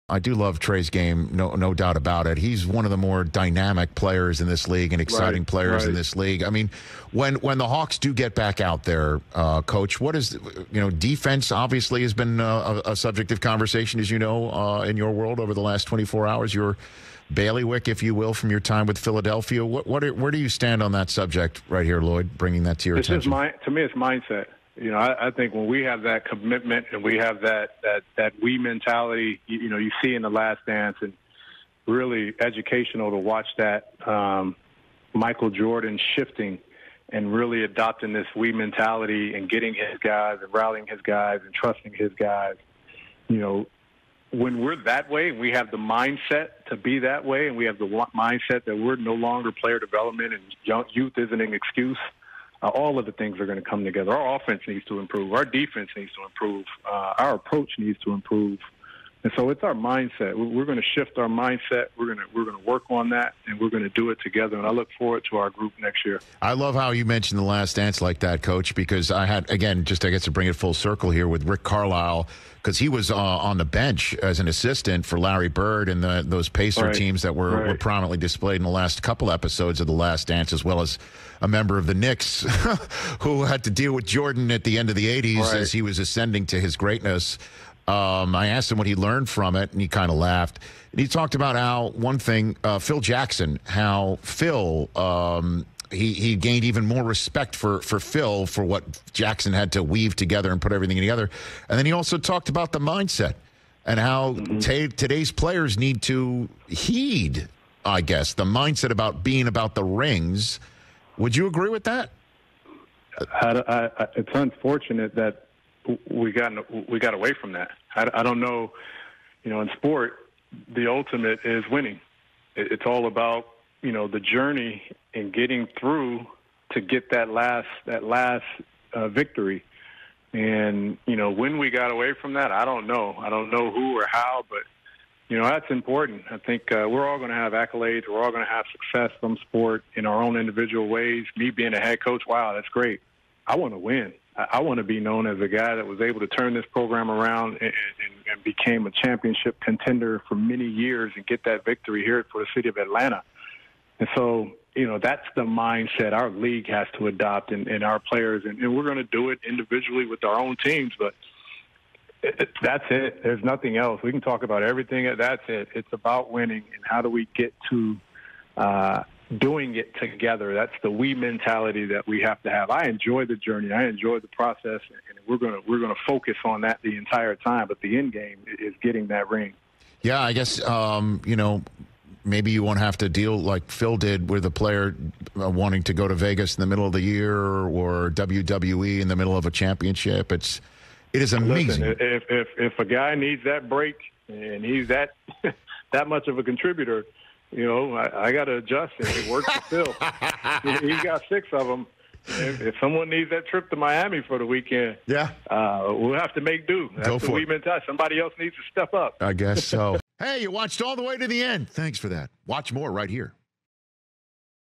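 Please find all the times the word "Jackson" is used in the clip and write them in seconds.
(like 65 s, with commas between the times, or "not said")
93 s, 99 s.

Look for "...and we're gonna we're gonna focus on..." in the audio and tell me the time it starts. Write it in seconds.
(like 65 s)
174 s.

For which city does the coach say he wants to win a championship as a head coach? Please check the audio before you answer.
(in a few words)
Atlanta.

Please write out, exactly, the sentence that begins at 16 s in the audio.
Your bailiwick, if you will, from your time with Philadelphia.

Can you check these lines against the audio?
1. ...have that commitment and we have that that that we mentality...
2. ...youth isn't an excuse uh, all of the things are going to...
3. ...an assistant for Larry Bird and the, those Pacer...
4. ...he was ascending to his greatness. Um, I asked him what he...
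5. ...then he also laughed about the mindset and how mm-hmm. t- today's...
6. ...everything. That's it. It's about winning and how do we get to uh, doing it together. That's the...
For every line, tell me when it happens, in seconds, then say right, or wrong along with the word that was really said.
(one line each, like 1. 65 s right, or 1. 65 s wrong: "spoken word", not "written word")
1. 25 s right
2. 50 s right
3. 74 s right
4. 85 s right
5. 101 s wrong: "talked", not "laughed"
6. 164 s right.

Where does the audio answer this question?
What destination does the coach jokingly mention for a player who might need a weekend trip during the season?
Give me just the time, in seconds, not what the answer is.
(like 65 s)
203 s.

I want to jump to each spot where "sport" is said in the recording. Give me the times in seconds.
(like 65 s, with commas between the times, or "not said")
119 s, 139 s.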